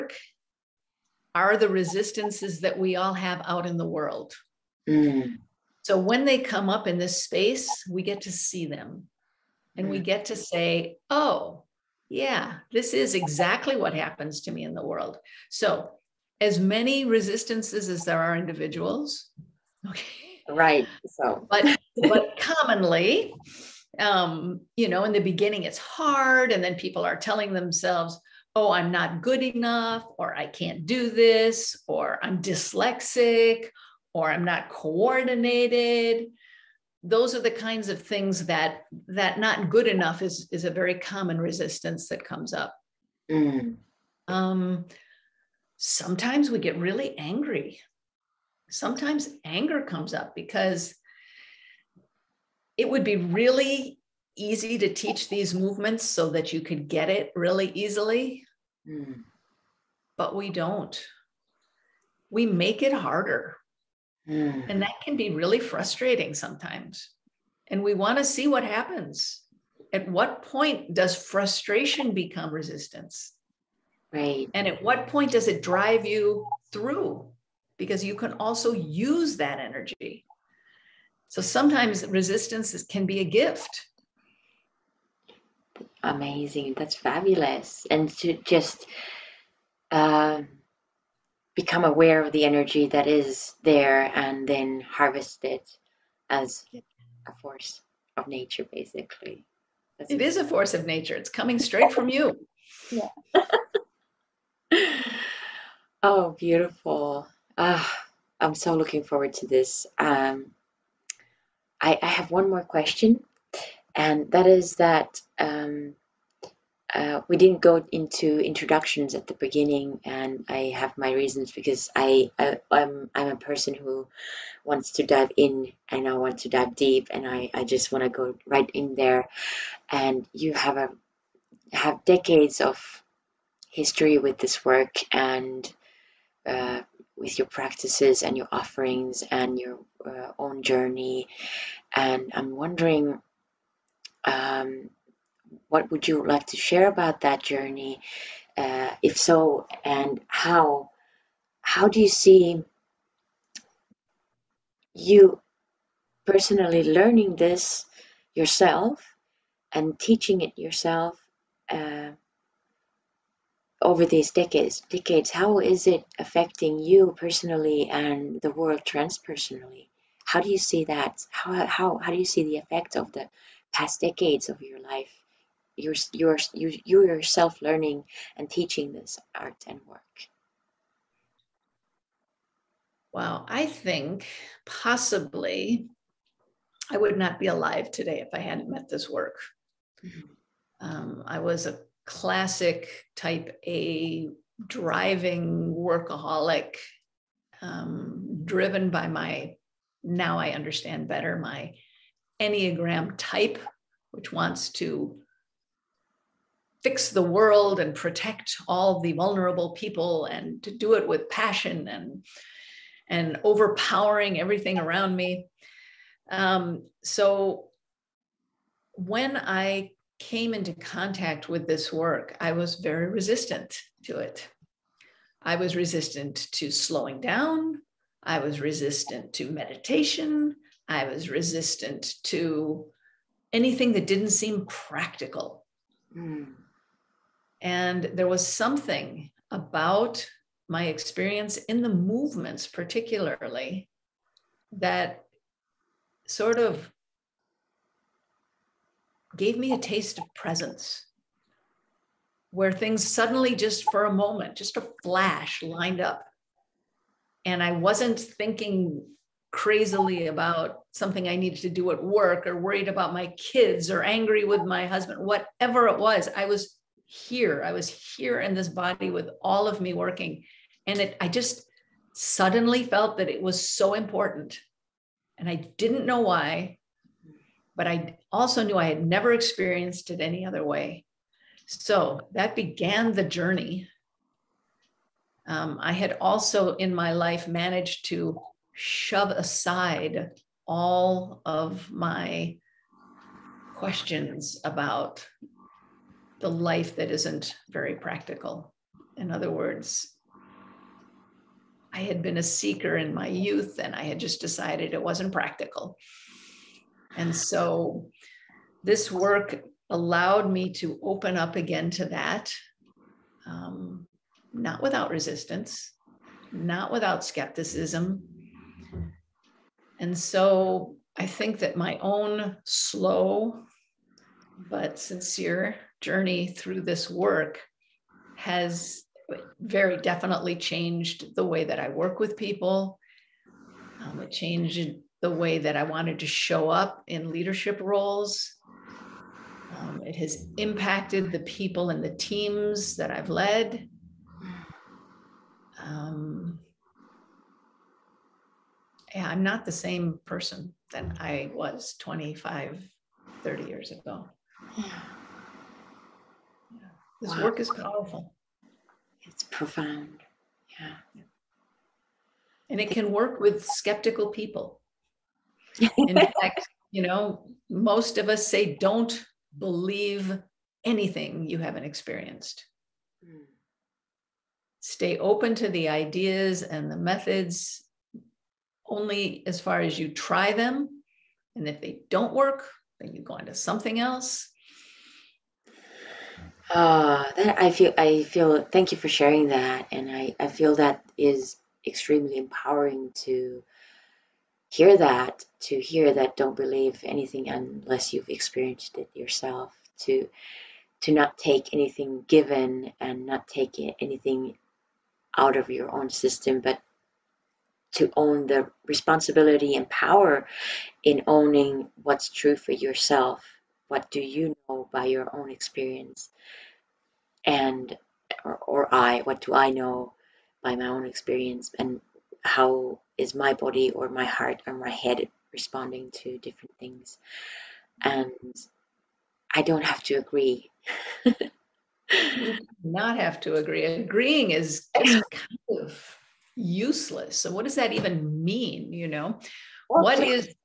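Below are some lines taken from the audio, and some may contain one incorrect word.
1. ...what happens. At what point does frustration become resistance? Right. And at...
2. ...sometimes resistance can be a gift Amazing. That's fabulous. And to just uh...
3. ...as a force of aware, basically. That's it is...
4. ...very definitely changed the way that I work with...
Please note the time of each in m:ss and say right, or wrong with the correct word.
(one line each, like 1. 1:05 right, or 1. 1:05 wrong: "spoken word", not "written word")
1. 1:08 right
2. 1:21 right
3. 1:36 wrong: "nature", not "aware"
4. 5:29 right.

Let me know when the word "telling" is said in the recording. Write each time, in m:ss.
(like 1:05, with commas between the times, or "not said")
0:27.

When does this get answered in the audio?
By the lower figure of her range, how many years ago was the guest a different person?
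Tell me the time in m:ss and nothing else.
5:51.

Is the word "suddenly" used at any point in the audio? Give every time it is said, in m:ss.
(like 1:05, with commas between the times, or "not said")
4:13, 4:32.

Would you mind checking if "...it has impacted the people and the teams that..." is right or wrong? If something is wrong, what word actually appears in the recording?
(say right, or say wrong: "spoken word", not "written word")
right.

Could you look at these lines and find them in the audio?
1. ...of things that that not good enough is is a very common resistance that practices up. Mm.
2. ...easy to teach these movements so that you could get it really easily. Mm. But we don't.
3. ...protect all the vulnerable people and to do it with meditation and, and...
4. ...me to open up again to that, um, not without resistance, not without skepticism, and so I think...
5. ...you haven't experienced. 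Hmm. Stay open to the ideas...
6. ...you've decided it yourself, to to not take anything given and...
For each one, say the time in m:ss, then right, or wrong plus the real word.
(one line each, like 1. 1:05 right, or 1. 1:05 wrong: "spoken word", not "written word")
1. 0:37 wrong: "comes", not "practices"
2. 0:54 right
3. 3:27 wrong: "passion", not "meditation"
4. 5:10 right
5. 6:11 right
6. 6:38 wrong: "experienced", not "decided".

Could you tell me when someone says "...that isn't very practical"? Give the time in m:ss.
4:56.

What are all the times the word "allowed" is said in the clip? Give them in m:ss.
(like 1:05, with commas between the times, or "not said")
5:09.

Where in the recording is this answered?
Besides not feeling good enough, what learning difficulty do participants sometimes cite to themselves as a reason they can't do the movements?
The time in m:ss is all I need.
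0:32.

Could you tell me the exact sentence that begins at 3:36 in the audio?
Um, so when I came into contact with this work, I was very resistant to it.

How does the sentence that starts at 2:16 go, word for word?
Uh, with your practices and your offerings and your uh, own journey.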